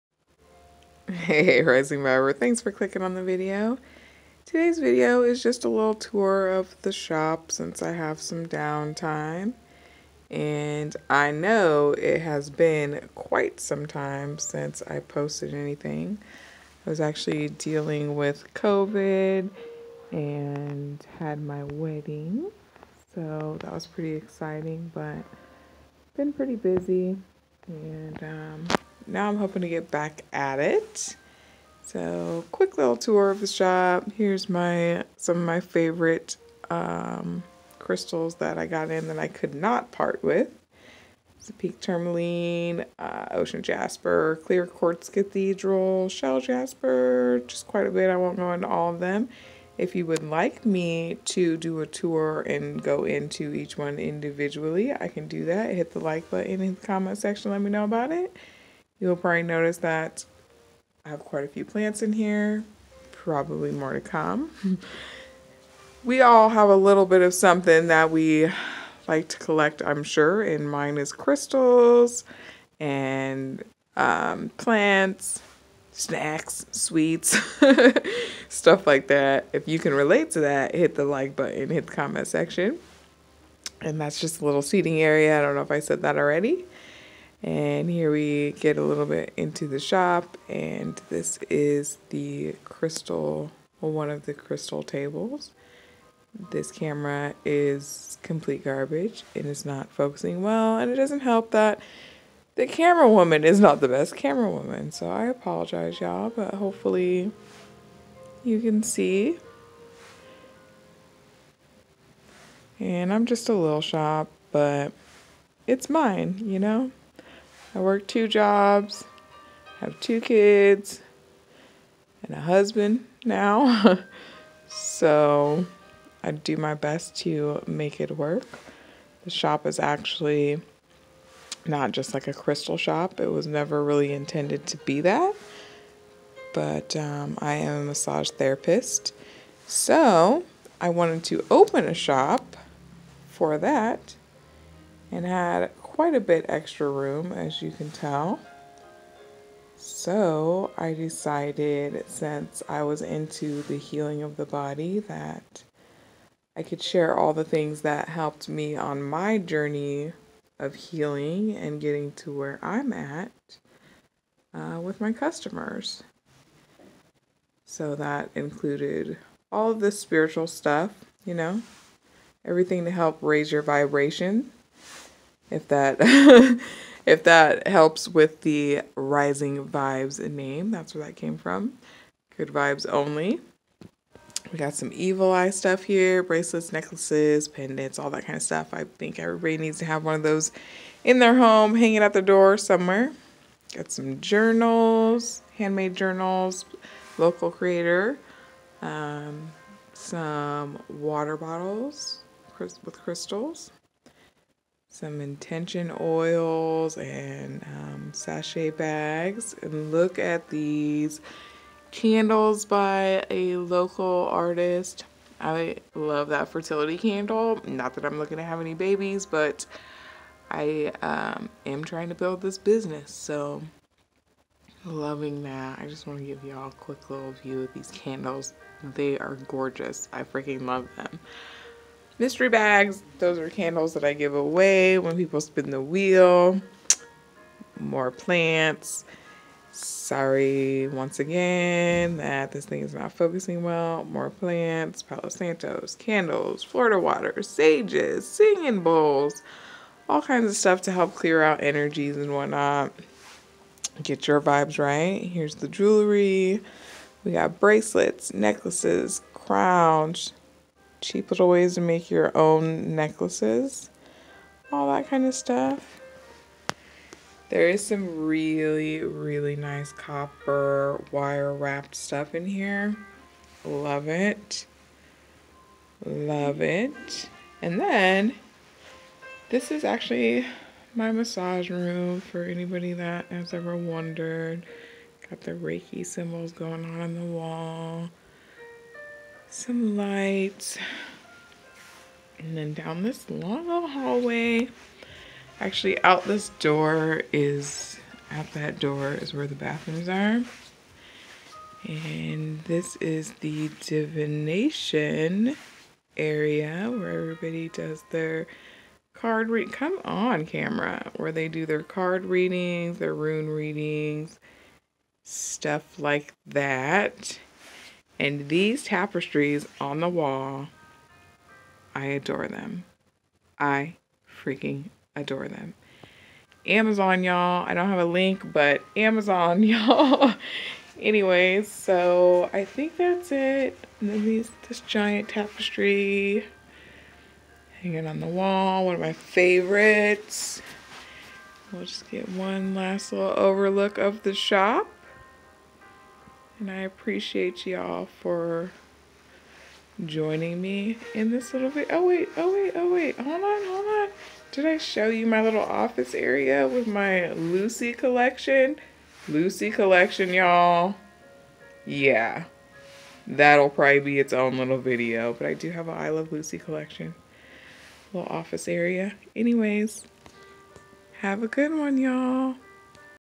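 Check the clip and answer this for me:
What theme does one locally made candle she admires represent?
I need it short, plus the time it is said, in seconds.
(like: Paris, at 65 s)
fertility, at 216 s.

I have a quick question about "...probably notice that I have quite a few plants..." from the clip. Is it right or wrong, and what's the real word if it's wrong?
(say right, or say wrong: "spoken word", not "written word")
right.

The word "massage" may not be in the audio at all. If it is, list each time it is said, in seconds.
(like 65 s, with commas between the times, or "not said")
137 s, 281 s.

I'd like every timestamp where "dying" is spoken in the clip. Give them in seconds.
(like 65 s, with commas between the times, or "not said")
not said.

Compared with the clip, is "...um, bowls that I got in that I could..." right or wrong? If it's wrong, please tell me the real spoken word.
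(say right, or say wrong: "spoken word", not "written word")
wrong: "crystals", not "bowls".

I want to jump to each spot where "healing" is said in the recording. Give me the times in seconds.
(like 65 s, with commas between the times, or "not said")
153 s, 160 s.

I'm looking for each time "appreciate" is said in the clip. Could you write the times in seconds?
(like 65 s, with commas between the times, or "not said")
346 s.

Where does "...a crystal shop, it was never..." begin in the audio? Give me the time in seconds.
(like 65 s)
132 s.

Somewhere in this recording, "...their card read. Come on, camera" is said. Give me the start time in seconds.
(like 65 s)
308 s.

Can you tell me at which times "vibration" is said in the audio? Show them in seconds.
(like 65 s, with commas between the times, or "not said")
173 s.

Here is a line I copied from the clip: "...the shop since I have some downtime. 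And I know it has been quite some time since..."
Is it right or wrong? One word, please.
right.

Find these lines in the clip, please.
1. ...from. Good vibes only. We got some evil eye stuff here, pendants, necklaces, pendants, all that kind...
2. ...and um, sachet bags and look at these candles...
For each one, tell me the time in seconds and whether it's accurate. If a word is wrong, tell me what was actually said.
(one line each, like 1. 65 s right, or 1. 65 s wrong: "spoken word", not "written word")
1. 181 s wrong: "bracelets", not "pendants"
2. 206 s right.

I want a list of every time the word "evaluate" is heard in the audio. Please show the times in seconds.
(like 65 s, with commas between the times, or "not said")
not said.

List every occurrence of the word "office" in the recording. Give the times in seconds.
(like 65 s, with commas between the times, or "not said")
355 s, 368 s.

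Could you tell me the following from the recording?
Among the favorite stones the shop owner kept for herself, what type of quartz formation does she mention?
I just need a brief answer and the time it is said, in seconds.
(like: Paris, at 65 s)
clear quartz cathedral, at 44 s.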